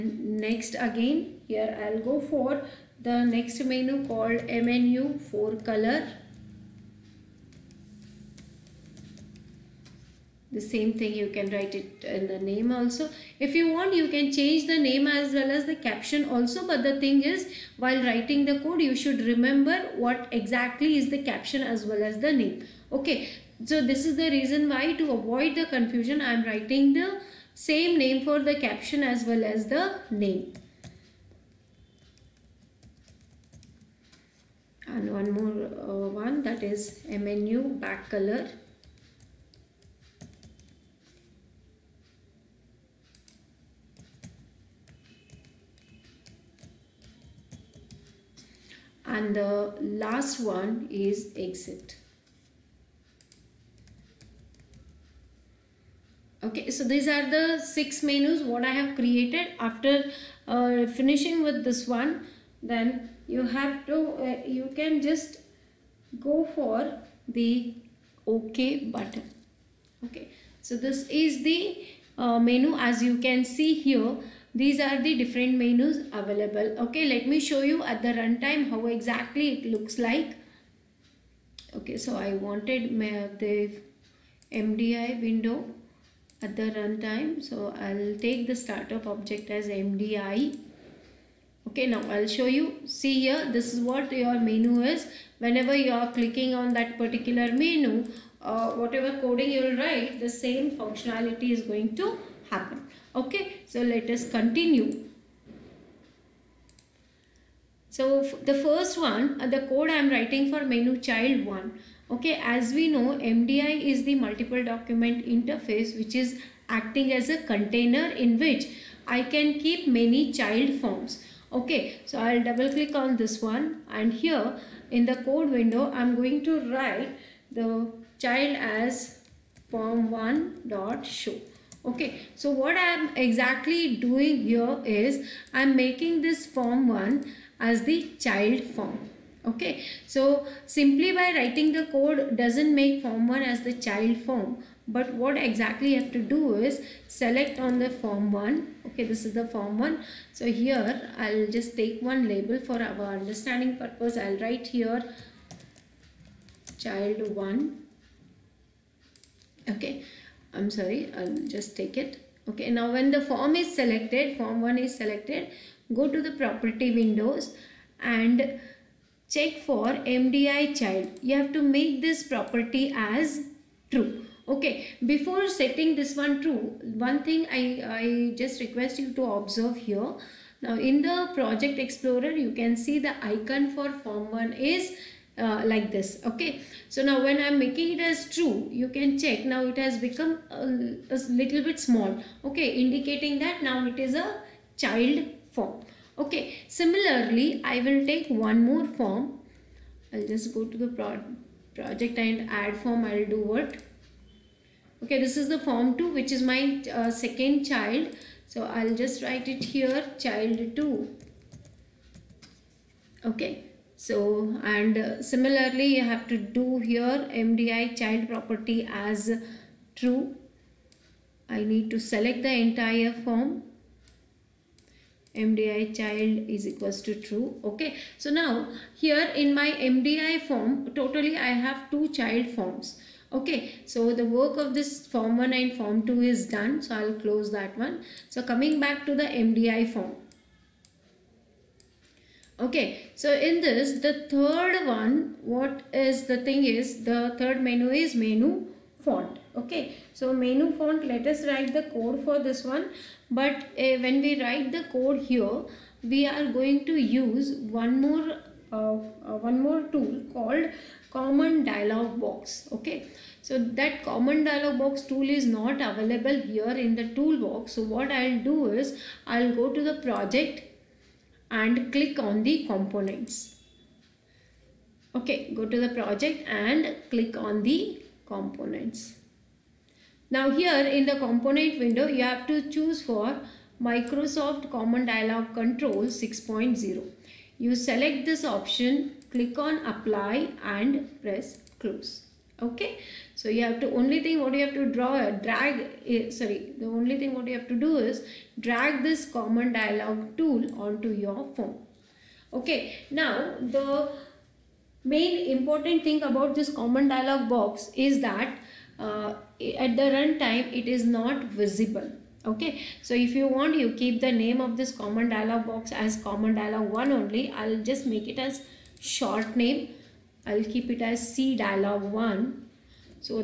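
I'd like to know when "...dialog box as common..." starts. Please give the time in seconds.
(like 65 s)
315 s.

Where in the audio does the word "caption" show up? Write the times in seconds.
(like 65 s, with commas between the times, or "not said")
15 s, 21 s, 28 s.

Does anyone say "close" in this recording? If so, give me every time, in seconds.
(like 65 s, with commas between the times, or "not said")
237 s, 291 s.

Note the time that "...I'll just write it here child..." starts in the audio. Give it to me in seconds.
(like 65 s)
208 s.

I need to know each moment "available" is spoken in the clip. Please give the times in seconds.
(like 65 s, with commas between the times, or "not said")
76 s, 265 s.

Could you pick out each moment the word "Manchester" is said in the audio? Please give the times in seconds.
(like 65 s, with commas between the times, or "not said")
not said.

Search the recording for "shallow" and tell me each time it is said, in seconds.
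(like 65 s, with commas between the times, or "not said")
not said.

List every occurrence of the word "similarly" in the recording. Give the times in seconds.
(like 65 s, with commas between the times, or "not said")
196 s, 215 s.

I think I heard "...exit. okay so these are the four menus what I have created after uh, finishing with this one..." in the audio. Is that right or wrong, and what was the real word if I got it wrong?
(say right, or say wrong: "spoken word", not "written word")
wrong: "six", not "four".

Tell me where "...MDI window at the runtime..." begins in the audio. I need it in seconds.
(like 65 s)
84 s.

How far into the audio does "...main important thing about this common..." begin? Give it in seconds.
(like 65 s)
305 s.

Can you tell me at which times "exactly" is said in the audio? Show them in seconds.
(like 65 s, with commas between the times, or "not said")
20 s, 78 s, 133 s, 145 s.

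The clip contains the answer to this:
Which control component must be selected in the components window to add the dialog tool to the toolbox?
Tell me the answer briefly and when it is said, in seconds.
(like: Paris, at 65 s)
Microsoft Common Dialog Control 6.0, at 283 s.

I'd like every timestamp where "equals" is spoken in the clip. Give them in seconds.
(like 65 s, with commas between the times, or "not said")
226 s.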